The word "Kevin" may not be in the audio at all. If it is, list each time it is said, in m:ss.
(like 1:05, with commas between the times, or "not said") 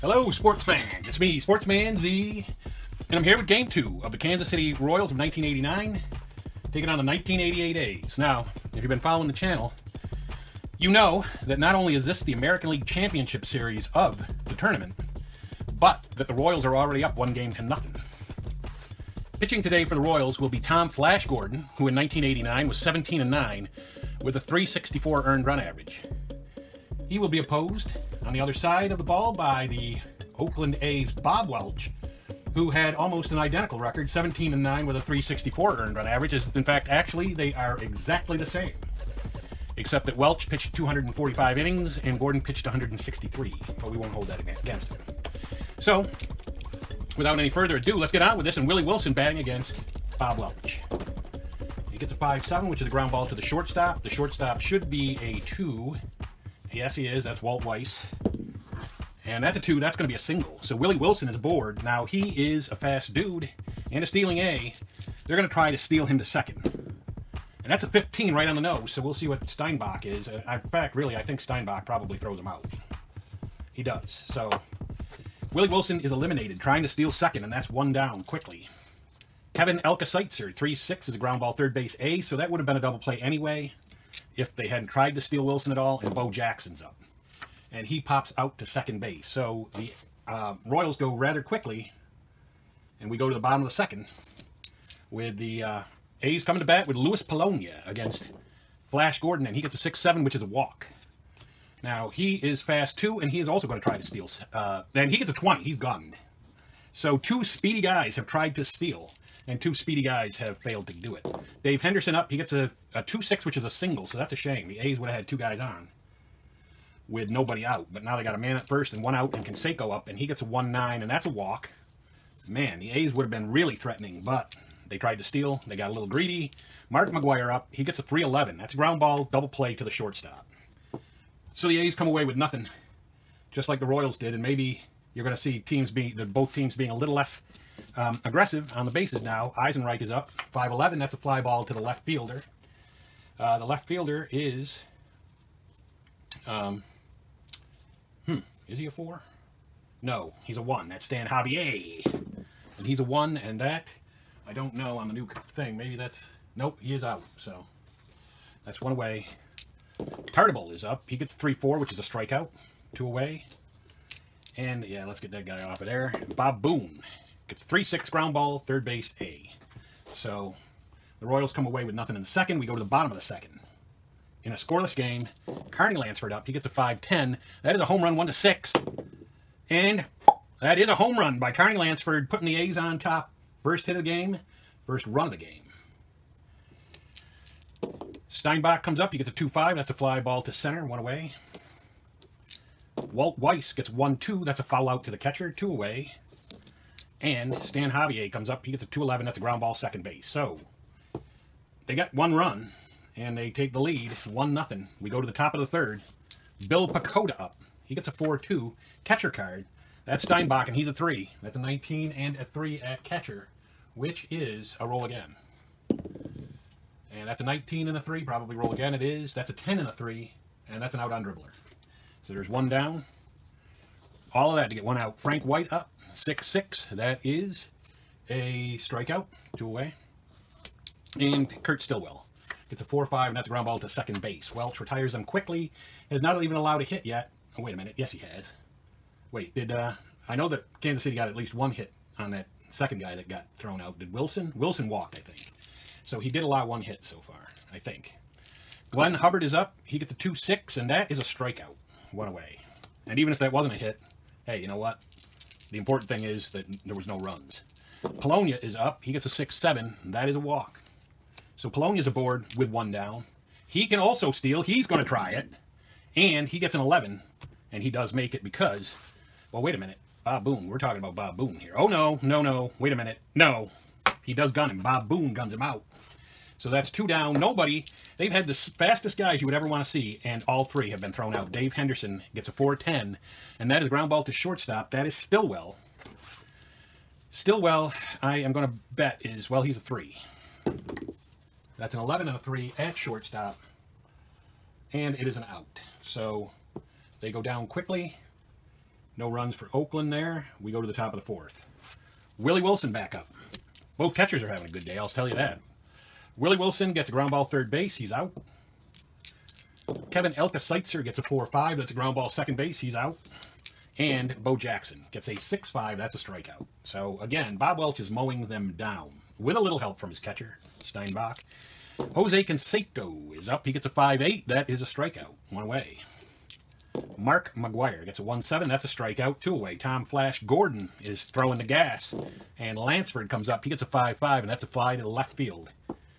1:19, 5:10.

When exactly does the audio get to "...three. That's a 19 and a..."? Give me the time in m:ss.
3:30.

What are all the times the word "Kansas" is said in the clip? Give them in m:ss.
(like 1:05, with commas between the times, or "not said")
0:04, 4:00.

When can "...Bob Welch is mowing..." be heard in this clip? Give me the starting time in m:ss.
5:17.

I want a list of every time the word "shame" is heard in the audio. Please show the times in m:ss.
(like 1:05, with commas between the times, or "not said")
1:54.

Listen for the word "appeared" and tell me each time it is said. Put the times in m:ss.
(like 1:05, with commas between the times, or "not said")
not said.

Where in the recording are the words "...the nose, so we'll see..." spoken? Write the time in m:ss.
1:08.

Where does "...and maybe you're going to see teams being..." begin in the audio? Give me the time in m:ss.
2:14.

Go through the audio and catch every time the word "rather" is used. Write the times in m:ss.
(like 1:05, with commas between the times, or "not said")
1:31.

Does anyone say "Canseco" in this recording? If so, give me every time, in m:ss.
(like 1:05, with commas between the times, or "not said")
1:59, 5:22.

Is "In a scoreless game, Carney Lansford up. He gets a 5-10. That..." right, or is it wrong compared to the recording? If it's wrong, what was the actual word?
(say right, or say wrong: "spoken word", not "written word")
right.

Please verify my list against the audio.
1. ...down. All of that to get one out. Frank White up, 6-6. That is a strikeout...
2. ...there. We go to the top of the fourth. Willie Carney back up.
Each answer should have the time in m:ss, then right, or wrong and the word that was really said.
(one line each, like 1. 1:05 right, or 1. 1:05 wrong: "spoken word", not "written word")
1. 3:42 right
2. 5:00 wrong: "Wilson", not "Carney".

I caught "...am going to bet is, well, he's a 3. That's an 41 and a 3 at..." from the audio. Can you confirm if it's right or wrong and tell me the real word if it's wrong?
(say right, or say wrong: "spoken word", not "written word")
wrong: "11", not "41".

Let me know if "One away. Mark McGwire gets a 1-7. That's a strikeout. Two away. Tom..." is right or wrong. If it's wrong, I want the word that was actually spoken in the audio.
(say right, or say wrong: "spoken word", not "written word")
right.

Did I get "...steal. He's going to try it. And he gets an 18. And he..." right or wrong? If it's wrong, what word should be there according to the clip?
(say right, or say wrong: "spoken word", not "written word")
wrong: "11", not "18".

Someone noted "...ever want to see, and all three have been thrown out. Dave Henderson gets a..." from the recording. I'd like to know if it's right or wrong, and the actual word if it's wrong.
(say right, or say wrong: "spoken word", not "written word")
right.